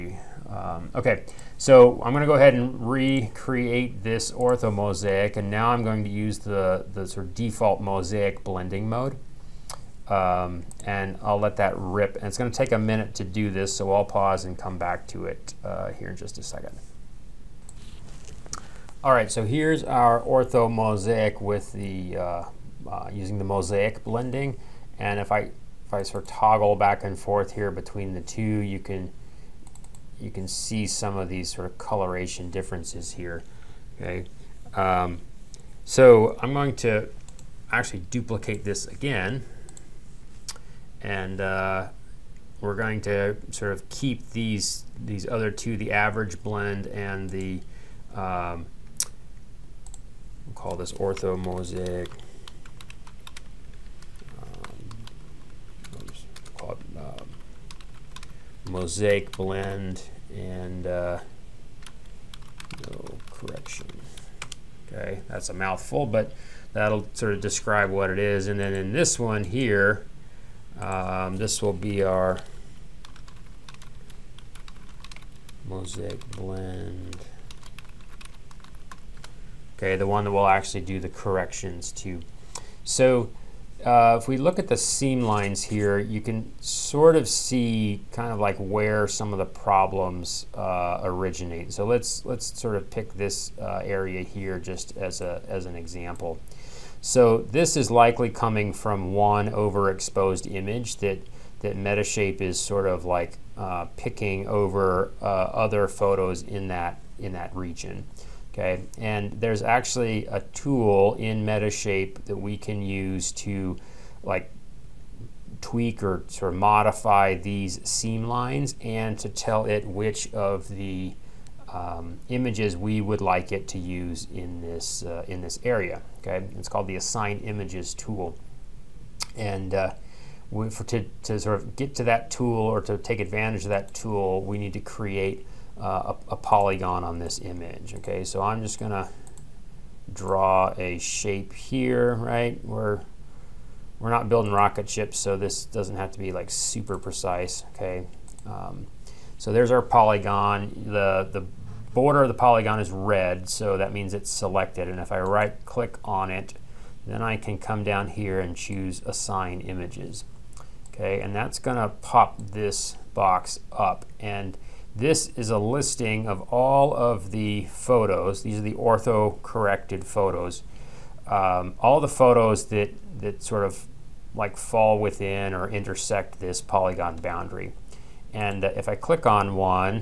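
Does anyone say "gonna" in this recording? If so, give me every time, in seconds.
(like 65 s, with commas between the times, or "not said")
2 s, 138 s, 161 s.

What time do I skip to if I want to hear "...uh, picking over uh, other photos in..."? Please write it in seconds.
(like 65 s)
103 s.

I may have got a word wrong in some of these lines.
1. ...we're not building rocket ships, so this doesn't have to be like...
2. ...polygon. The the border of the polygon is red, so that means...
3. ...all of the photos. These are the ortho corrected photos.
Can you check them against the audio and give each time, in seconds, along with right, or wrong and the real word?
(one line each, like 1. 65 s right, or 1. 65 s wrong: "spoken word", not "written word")
1. 143 s right
2. 149 s right
3. 166 s right.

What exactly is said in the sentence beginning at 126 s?
Okay, it's called the Assign Images tool.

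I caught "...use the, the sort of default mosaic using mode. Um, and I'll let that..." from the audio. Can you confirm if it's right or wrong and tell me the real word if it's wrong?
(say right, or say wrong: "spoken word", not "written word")
wrong: "blending", not "using".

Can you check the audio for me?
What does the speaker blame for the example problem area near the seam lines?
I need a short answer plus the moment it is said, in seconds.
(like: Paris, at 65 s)
One overexposed image, at 99 s.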